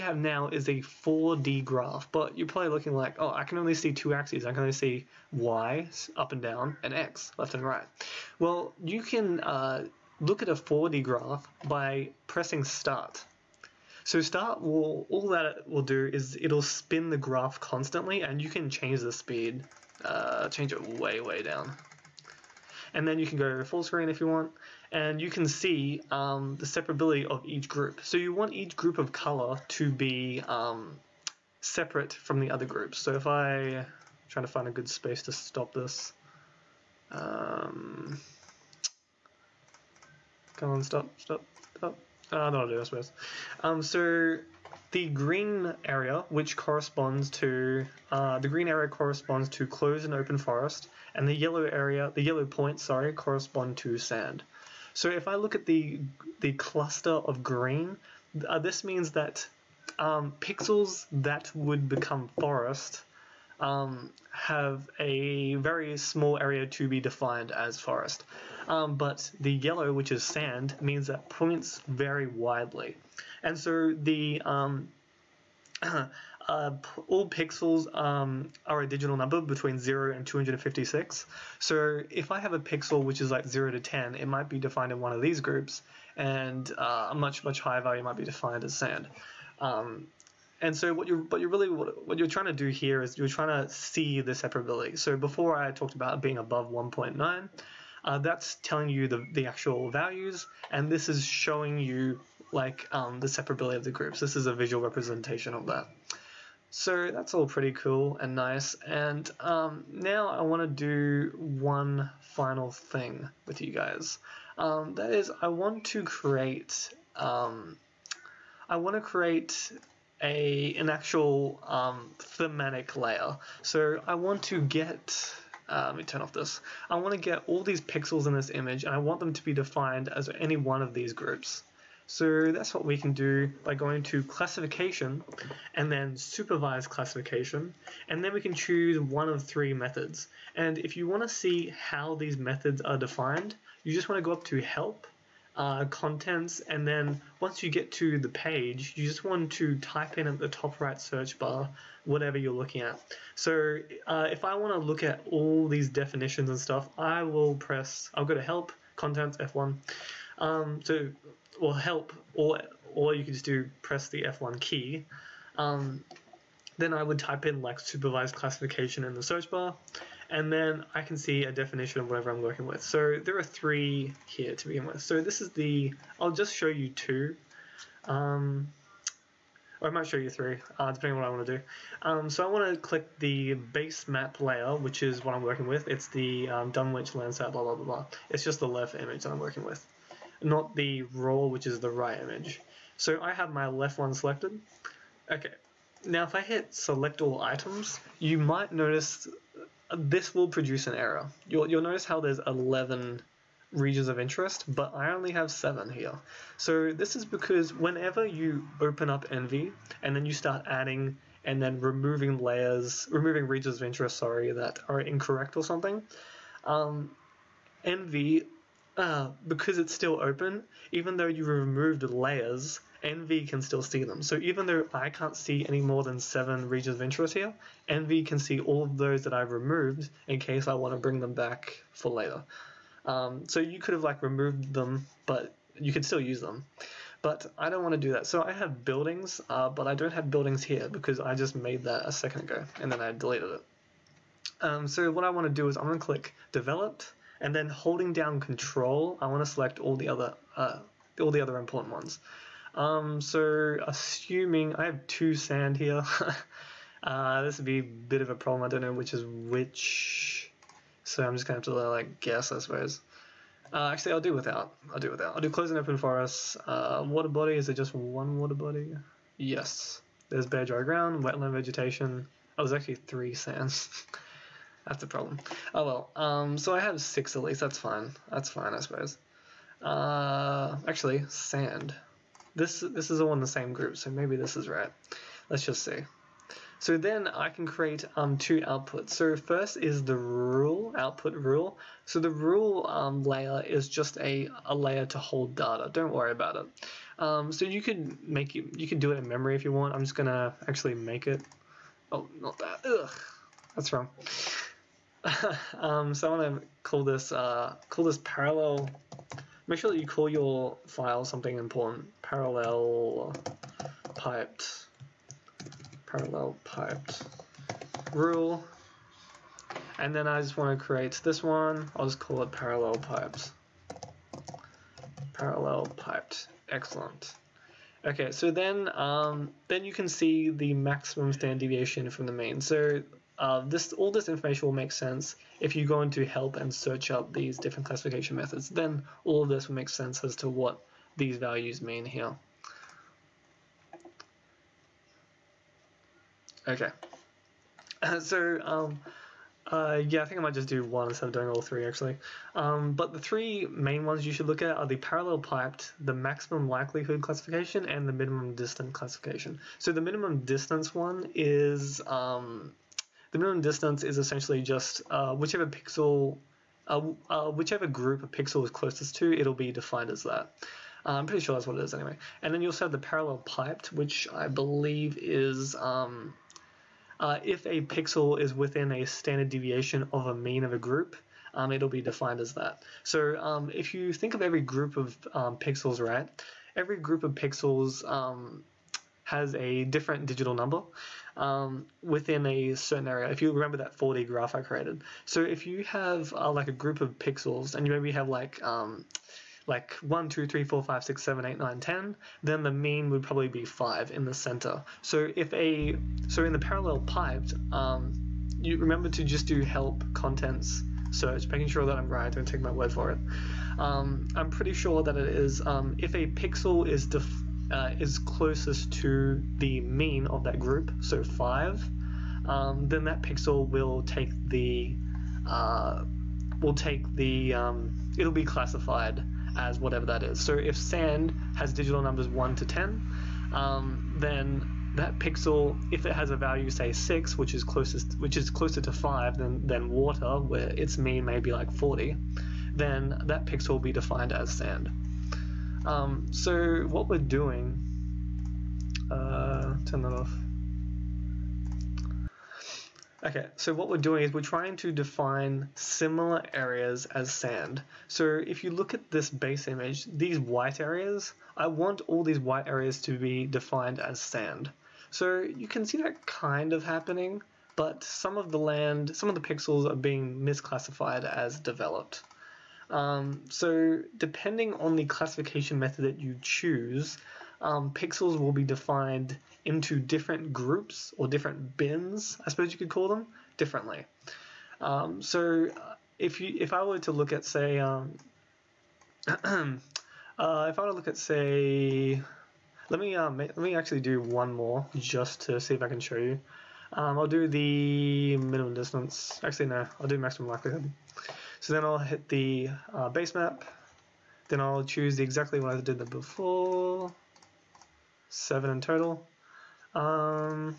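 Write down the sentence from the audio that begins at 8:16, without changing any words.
Um, I'll do the minimum distance.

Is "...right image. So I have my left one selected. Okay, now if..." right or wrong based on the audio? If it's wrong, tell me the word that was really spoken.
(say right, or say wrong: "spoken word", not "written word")
right.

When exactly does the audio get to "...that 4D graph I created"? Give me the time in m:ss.
6:33.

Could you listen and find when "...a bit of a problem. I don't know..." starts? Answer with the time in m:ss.
4:17.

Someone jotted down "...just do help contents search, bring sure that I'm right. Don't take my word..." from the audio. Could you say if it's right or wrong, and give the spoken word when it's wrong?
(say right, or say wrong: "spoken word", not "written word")
wrong: "making", not "bring".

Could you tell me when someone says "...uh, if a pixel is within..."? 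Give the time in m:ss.
6:17.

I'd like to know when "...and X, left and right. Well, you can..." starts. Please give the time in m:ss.
0:06.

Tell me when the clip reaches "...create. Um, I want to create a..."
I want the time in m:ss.
1:56.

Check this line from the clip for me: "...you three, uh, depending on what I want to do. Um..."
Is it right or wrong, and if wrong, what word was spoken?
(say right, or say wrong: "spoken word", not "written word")
right.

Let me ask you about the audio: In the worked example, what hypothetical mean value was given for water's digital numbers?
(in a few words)
40.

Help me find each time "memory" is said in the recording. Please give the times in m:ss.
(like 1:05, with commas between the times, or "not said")
4:59.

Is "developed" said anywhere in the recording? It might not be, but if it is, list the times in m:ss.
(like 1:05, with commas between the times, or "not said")
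4:06, 7:51.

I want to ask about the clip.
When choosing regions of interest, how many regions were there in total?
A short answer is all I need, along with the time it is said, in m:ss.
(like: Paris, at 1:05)
11, at 3:22.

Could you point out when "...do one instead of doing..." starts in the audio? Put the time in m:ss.
5:50.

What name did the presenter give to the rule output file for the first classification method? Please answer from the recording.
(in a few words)
Parallel piped rule.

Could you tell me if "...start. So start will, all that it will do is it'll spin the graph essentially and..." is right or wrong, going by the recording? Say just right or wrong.
wrong.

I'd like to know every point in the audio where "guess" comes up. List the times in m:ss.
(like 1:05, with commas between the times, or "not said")
4:22.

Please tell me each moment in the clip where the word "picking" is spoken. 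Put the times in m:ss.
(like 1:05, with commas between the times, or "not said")
not said.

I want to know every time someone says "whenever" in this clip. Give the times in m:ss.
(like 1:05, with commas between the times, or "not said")
3:27.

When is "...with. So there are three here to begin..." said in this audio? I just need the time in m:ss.
2:52.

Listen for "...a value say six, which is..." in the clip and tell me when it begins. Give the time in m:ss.
7:16.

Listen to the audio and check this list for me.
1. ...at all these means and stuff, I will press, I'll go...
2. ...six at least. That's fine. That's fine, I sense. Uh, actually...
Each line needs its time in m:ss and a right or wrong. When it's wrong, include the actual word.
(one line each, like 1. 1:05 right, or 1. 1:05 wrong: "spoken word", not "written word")
1. 2:35 wrong: "definitions", not "means"
2. 4:36 wrong: "suppose", not "sense".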